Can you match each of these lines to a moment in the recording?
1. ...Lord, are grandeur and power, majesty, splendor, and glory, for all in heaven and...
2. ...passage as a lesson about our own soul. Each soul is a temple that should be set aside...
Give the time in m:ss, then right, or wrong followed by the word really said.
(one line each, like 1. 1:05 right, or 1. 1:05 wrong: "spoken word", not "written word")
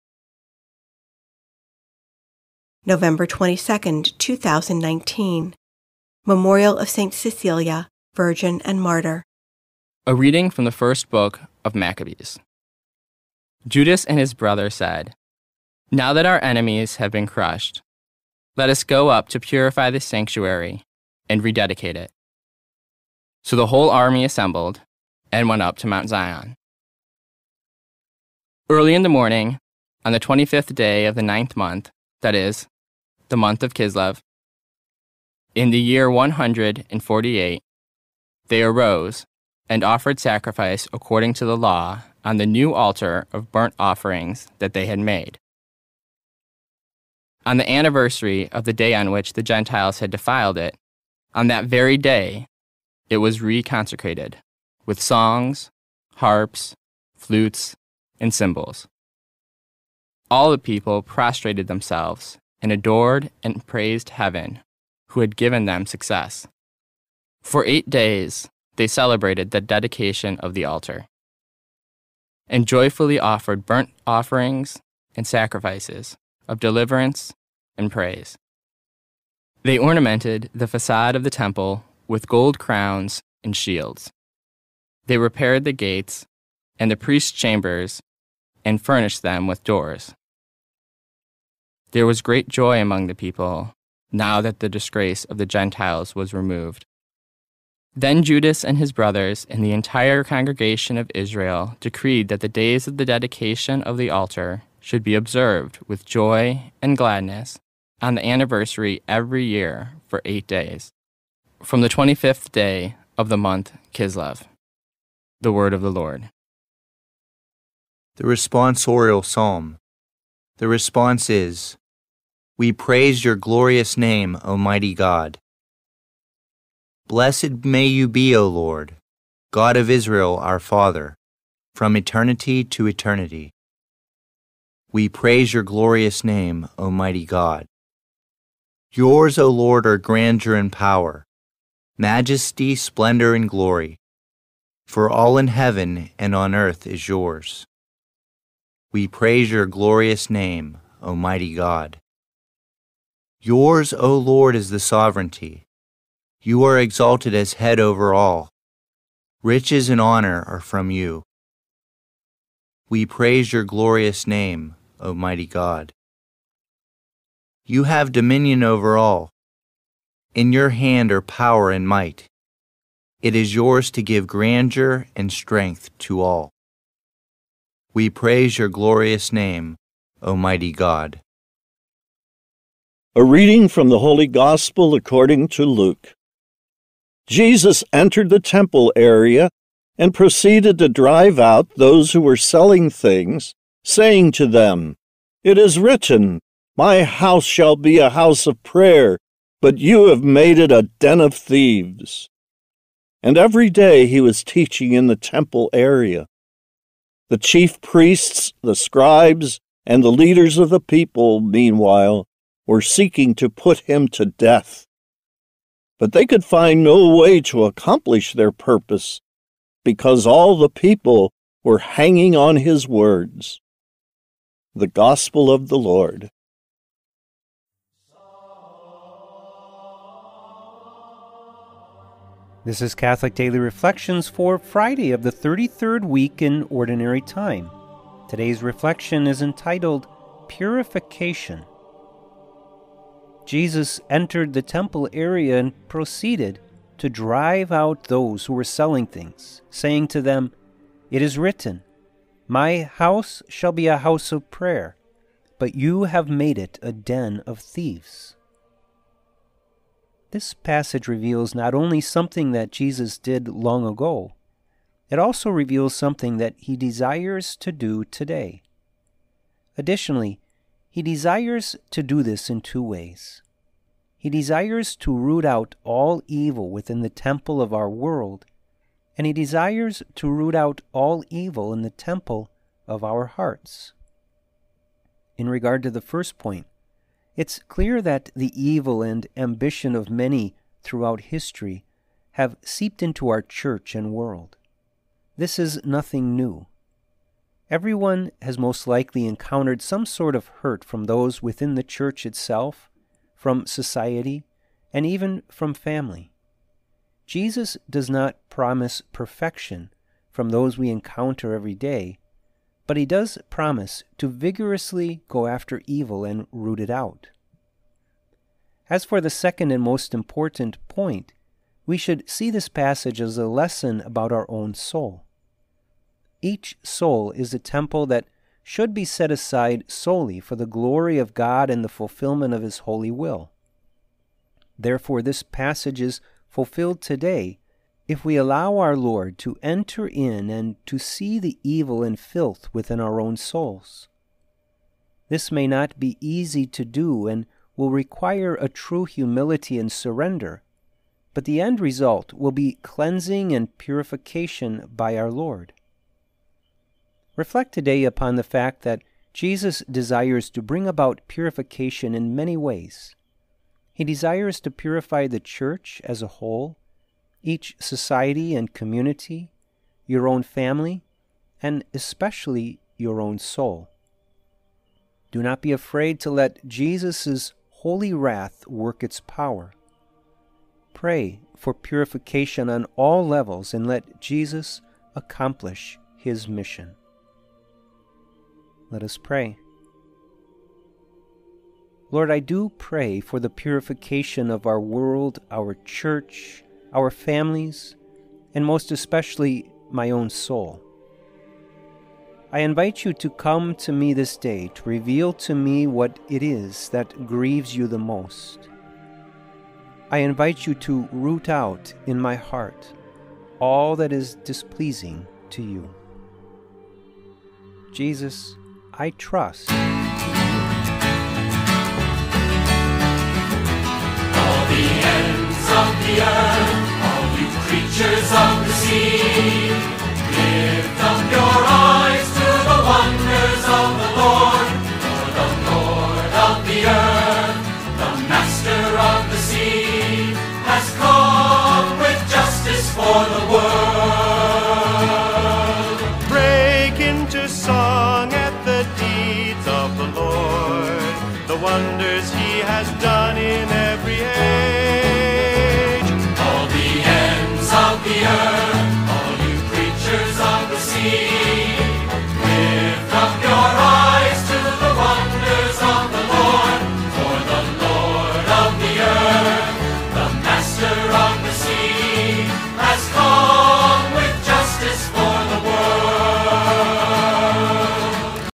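1. 2:19 right
2. 5:22 right.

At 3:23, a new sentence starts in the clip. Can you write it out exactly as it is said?
And every day he was teaching in the temple area.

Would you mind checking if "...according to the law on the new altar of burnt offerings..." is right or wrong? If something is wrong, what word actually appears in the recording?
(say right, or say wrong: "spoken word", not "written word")
right.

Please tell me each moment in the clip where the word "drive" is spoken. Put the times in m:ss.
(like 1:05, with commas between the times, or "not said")
3:10, 4:07.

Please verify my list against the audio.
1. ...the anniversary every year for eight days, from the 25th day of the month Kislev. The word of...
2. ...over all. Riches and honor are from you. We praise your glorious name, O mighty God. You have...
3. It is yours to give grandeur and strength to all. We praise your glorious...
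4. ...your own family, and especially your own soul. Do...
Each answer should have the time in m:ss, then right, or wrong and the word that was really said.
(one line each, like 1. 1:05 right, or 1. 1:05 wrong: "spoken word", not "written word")
1. 1:48 right
2. 2:37 right
3. 2:53 right
4. 6:10 right.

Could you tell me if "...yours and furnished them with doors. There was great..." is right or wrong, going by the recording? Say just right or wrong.
wrong.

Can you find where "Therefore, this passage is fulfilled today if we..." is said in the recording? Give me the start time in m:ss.
5:34.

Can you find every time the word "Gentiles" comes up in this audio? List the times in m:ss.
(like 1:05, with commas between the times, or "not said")
0:49, 1:35.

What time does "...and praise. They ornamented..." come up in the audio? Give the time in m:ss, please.
1:17.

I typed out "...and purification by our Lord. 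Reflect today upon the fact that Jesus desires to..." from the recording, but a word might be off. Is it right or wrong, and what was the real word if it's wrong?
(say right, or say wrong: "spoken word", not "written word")
right.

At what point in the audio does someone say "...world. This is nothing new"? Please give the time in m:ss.
4:54.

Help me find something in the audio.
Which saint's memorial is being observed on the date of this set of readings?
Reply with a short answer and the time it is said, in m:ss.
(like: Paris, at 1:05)
St. Cecilia, at 0:06.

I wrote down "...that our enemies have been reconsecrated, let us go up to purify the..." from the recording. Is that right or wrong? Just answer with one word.
wrong.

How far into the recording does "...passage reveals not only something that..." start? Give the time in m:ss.
4:20.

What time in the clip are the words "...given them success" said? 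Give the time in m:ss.
1:05.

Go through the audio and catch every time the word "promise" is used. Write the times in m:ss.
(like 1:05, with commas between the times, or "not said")
5:08, 5:13.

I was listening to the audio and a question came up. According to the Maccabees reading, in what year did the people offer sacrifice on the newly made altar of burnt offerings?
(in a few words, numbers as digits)
148.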